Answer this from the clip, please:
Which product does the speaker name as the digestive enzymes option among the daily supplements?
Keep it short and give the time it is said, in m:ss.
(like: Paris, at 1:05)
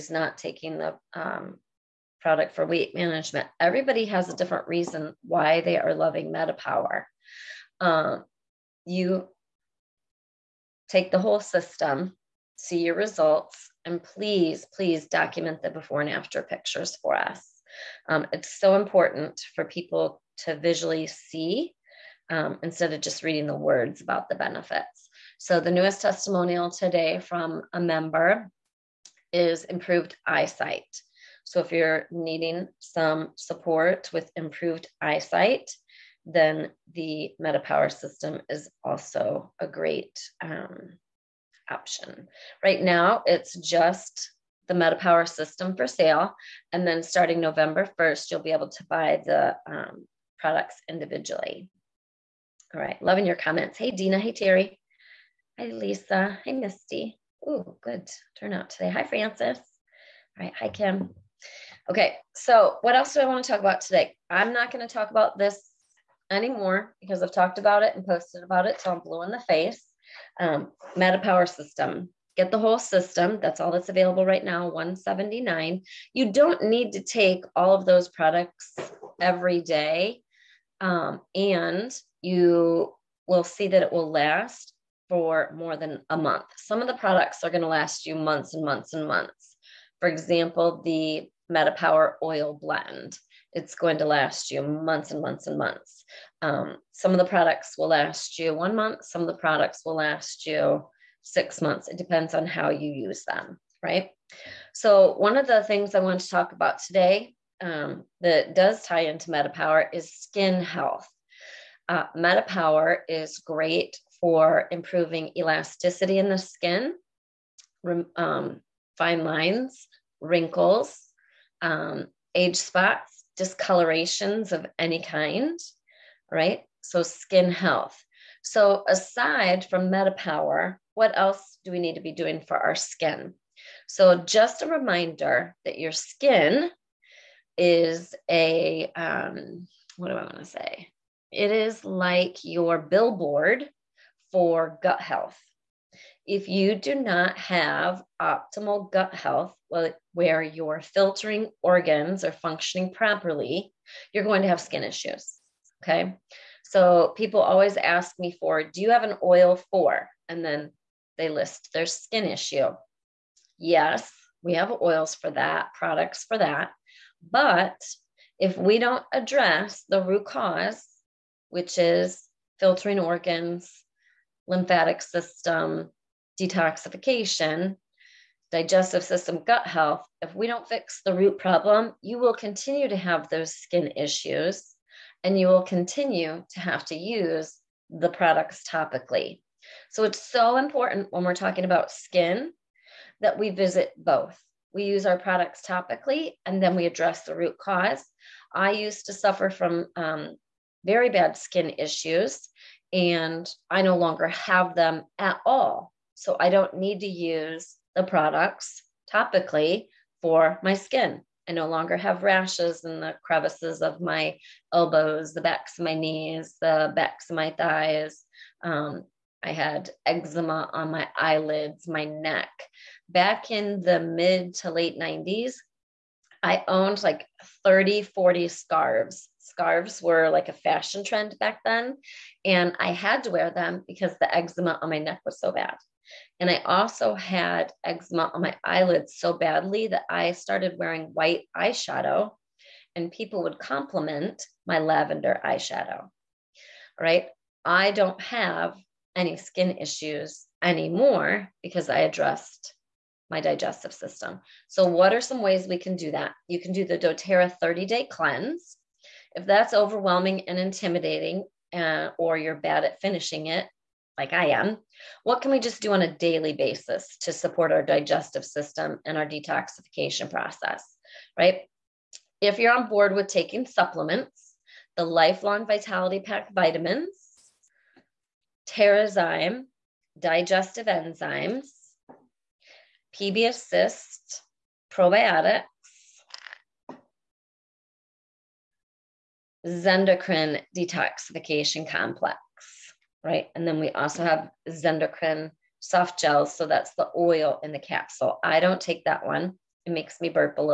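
Terrazyme, at 4:38.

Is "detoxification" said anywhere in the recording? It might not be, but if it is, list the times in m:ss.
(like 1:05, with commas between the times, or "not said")
2:56, 4:29, 4:50.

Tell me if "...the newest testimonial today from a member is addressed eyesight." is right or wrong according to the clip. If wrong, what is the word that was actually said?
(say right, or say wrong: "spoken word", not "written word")
wrong: "improved", not "addressed".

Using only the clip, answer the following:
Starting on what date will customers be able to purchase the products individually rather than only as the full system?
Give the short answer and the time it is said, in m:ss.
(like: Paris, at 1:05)
November 1st, at 0:47.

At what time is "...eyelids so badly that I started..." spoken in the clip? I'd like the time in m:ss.
3:58.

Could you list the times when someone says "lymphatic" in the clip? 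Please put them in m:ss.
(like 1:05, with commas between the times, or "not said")
2:54.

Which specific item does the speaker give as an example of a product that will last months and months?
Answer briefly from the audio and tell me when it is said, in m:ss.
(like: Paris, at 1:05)
MetaPower oil blend, at 1:31.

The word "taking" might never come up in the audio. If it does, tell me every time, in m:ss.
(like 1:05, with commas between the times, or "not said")
0:00, 4:33.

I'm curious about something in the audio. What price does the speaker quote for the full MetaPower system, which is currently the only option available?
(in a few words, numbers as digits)
179.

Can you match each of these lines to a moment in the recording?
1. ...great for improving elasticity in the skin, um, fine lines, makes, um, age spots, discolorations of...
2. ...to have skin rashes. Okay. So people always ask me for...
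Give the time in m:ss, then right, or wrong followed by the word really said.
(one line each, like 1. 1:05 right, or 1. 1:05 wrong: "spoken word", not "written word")
1. 1:53 wrong: "wrinkles", not "makes"
2. 2:34 wrong: "issues", not "rashes".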